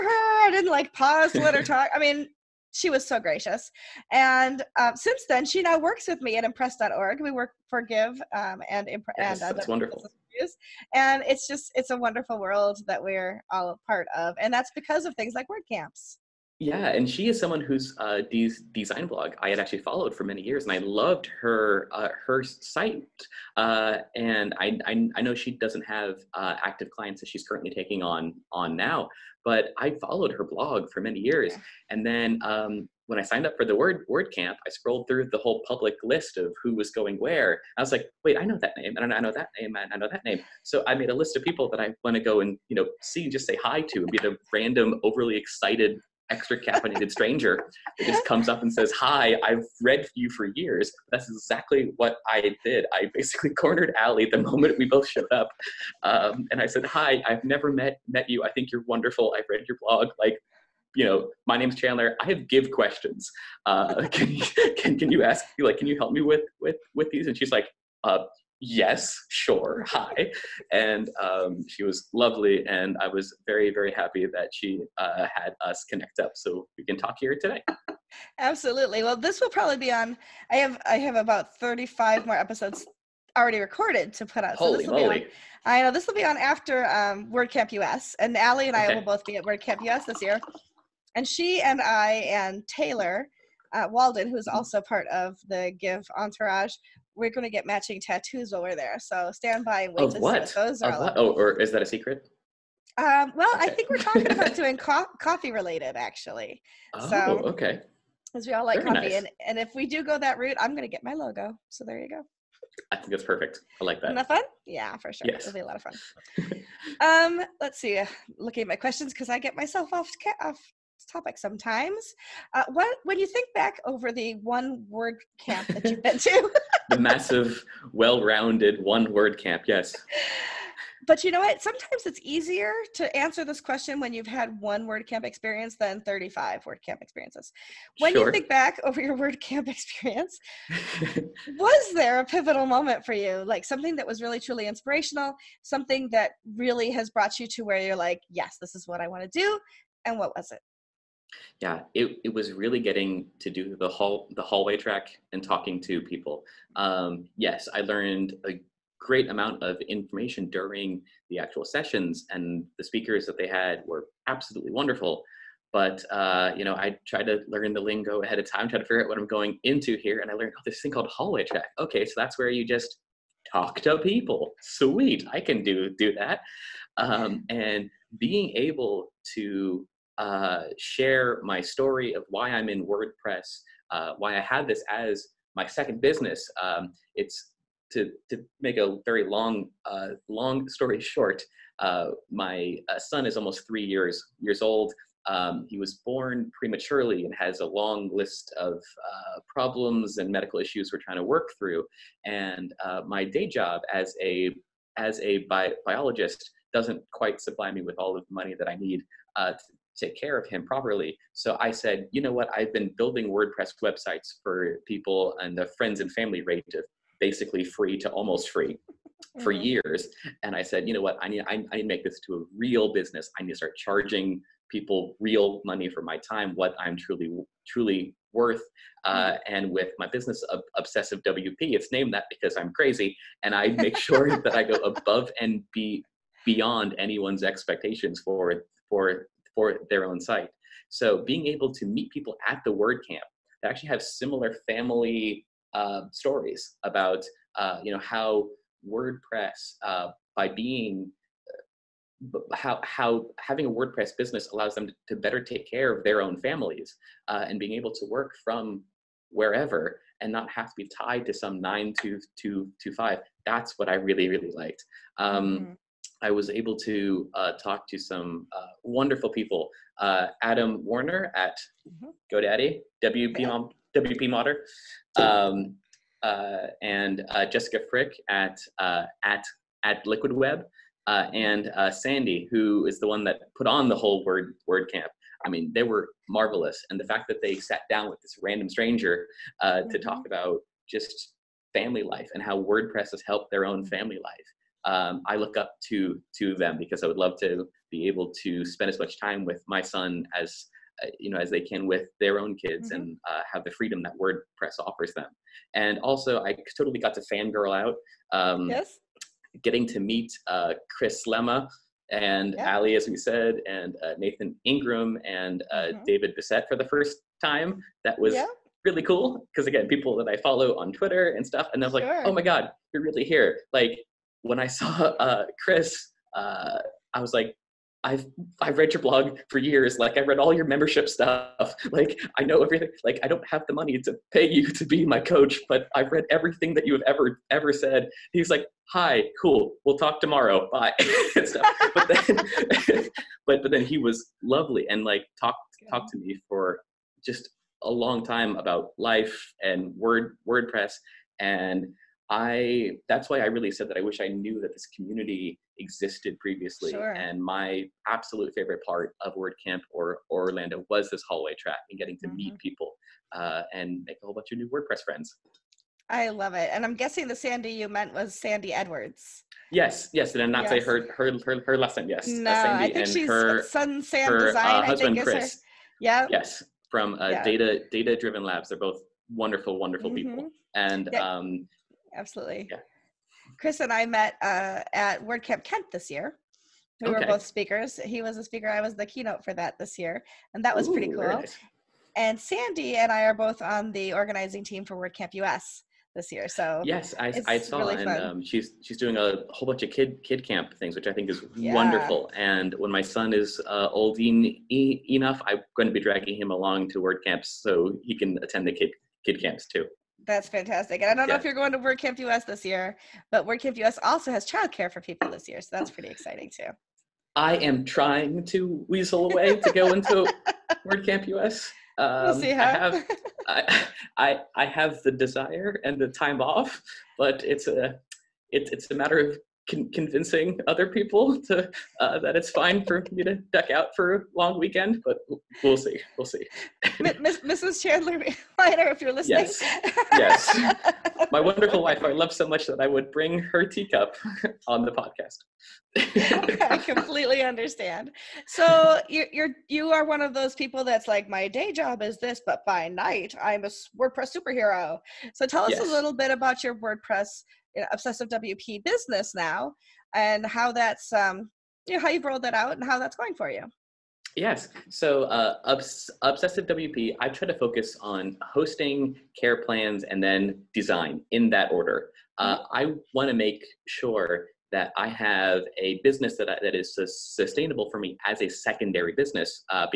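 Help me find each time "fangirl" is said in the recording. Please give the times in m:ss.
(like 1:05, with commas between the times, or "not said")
5:07.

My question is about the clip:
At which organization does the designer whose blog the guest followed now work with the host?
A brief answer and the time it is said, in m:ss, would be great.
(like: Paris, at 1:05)
impress.org, at 0:06.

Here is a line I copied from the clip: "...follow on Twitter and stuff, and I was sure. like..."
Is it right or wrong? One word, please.
right.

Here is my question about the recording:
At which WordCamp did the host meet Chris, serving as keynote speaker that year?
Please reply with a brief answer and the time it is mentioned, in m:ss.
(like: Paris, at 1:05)
WordCamp Kent, at 6:25.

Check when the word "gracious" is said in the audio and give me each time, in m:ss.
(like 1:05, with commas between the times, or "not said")
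0:03.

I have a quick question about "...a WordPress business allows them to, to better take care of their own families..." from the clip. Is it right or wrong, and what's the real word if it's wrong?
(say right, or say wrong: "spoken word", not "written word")
right.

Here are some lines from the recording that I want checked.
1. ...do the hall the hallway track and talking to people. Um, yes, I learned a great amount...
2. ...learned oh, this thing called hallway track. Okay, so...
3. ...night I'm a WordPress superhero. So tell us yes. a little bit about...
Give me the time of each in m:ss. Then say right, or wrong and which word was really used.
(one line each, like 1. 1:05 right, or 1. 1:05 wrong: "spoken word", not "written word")
1. 2:33 right
2. 2:50 right
3. 7:32 right.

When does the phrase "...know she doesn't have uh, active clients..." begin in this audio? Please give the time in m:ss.
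0:25.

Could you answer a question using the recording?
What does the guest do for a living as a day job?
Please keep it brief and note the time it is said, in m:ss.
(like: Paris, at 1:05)
Biologist, at 3:25.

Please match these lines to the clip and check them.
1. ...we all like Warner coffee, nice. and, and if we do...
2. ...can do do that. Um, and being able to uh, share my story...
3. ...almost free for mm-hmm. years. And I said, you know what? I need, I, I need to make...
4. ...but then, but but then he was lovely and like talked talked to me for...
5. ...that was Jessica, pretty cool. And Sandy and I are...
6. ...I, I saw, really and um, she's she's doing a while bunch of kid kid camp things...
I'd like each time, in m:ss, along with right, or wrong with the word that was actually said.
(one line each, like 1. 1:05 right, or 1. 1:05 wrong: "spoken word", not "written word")
1. 1:48 wrong: "Very", not "Warner"
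2. 2:55 right
3. 3:38 right
4. 5:41 right
5. 6:30 wrong: "Ooh", not "Jessica"
6. 6:37 wrong: "whole", not "while".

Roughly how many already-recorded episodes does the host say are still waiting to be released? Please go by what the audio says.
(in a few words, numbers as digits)
35.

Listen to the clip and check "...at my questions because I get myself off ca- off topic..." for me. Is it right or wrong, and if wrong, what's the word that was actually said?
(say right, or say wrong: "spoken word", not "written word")
right.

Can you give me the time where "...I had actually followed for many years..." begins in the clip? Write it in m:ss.
0:19.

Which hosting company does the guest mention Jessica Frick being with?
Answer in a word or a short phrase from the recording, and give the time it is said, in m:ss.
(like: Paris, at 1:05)
Liquid Web, at 4:40.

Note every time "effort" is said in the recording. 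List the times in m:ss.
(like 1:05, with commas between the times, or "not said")
not said.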